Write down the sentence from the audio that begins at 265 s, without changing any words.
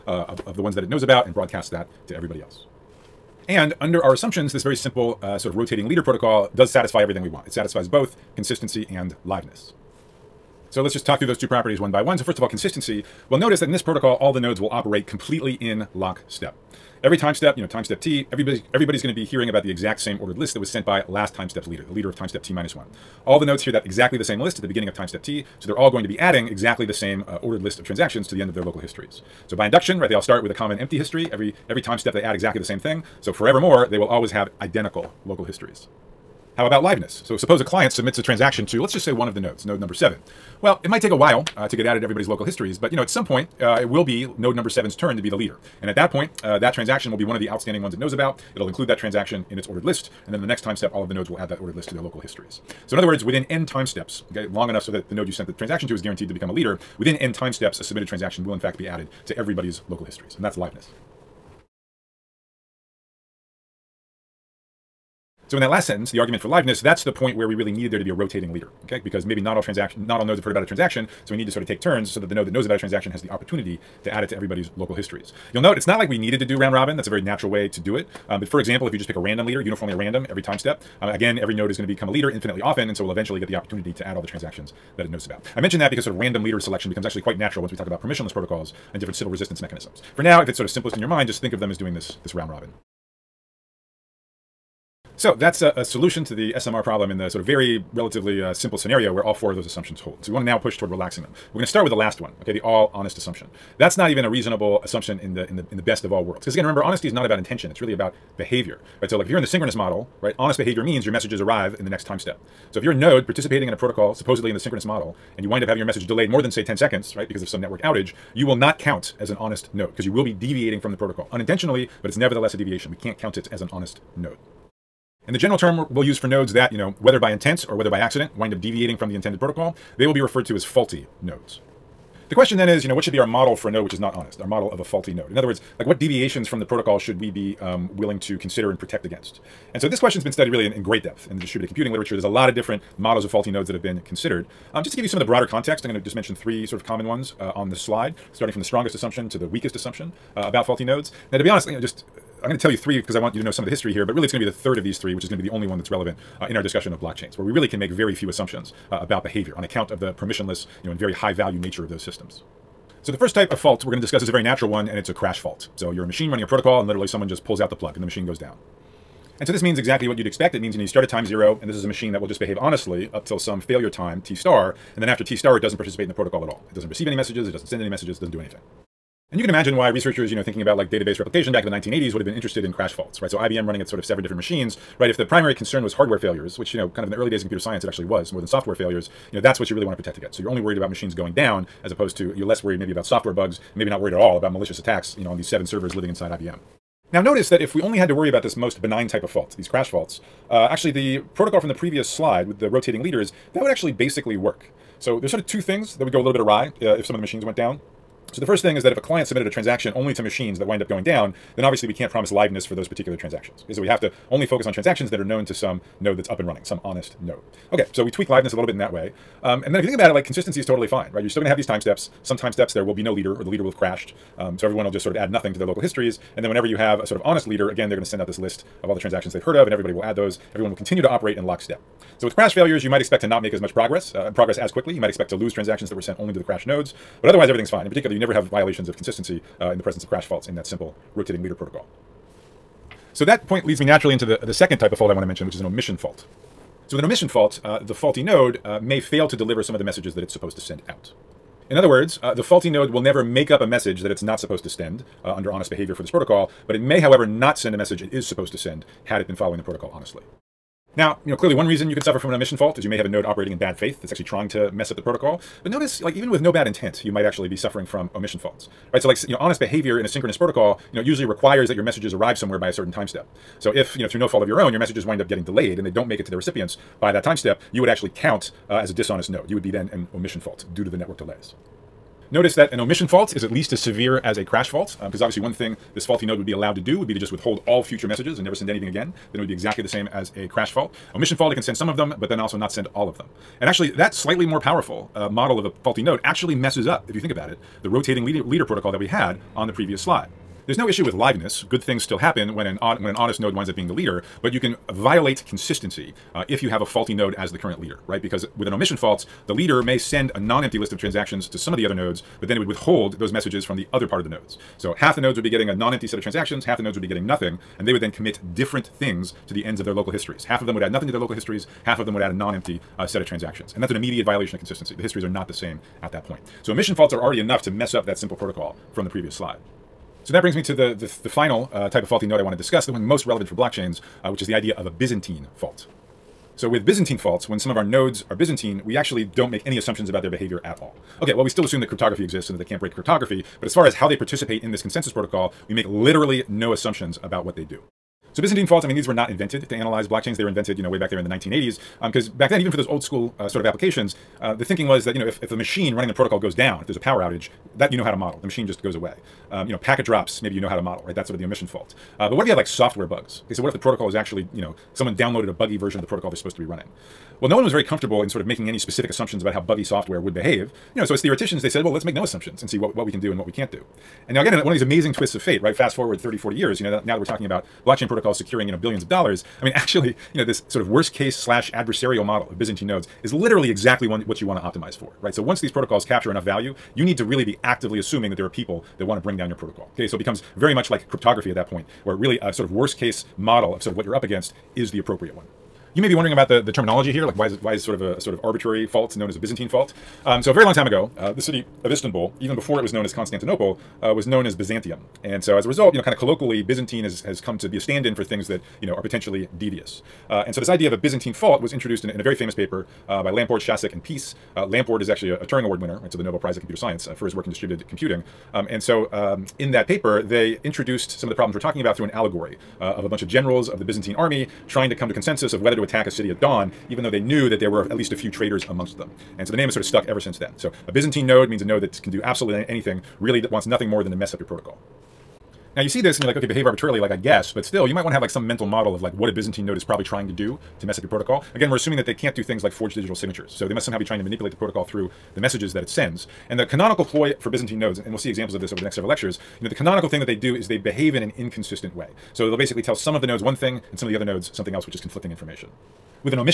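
But notice, like, even with no bad intent, you might actually be suffering from omission faults right?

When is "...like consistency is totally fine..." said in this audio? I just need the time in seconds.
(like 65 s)
220 s.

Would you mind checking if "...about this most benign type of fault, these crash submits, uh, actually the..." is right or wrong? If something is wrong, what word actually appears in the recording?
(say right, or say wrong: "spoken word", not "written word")
wrong: "faults", not "submits".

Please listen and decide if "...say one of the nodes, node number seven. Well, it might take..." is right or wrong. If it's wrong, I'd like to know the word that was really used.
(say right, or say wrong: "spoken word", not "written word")
right.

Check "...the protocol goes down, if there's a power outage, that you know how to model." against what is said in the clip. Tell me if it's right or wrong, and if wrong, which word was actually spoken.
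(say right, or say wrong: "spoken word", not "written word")
right.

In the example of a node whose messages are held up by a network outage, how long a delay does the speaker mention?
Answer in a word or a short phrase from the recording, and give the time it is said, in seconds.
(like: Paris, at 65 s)
10 seconds, at 116 s.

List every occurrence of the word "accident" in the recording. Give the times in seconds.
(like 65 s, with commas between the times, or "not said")
127 s.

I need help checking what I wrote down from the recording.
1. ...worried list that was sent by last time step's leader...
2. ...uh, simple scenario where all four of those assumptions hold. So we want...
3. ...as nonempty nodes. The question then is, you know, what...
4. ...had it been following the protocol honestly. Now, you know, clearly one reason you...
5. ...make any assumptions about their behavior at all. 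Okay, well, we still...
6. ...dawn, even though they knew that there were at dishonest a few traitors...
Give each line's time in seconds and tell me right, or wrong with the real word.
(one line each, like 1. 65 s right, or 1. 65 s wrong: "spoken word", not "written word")
1. 20 s wrong: "ordered", not "worried"
2. 98 s right
3. 130 s wrong: "faulty", not "nonempty"
4. 259 s right
5. 339 s right
6. 426 s wrong: "least", not "dishonest".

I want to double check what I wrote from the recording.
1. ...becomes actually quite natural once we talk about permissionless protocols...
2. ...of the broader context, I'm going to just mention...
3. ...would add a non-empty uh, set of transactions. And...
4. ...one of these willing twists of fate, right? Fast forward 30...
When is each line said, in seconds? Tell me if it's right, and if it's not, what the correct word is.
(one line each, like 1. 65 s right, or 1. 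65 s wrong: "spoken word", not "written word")
1. 86 s right
2. 145 s right
3. 322 s right
4. 374 s wrong: "amazing", not "willing".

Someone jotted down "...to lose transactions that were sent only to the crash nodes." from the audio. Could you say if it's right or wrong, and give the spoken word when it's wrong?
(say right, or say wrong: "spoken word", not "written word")
right.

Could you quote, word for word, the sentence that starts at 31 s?
Every, every time step they add exactly the same thing.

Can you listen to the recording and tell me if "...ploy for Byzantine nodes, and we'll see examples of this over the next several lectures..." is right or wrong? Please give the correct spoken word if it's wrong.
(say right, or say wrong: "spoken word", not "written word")
right.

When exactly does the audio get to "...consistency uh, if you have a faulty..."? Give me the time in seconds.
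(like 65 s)
305 s.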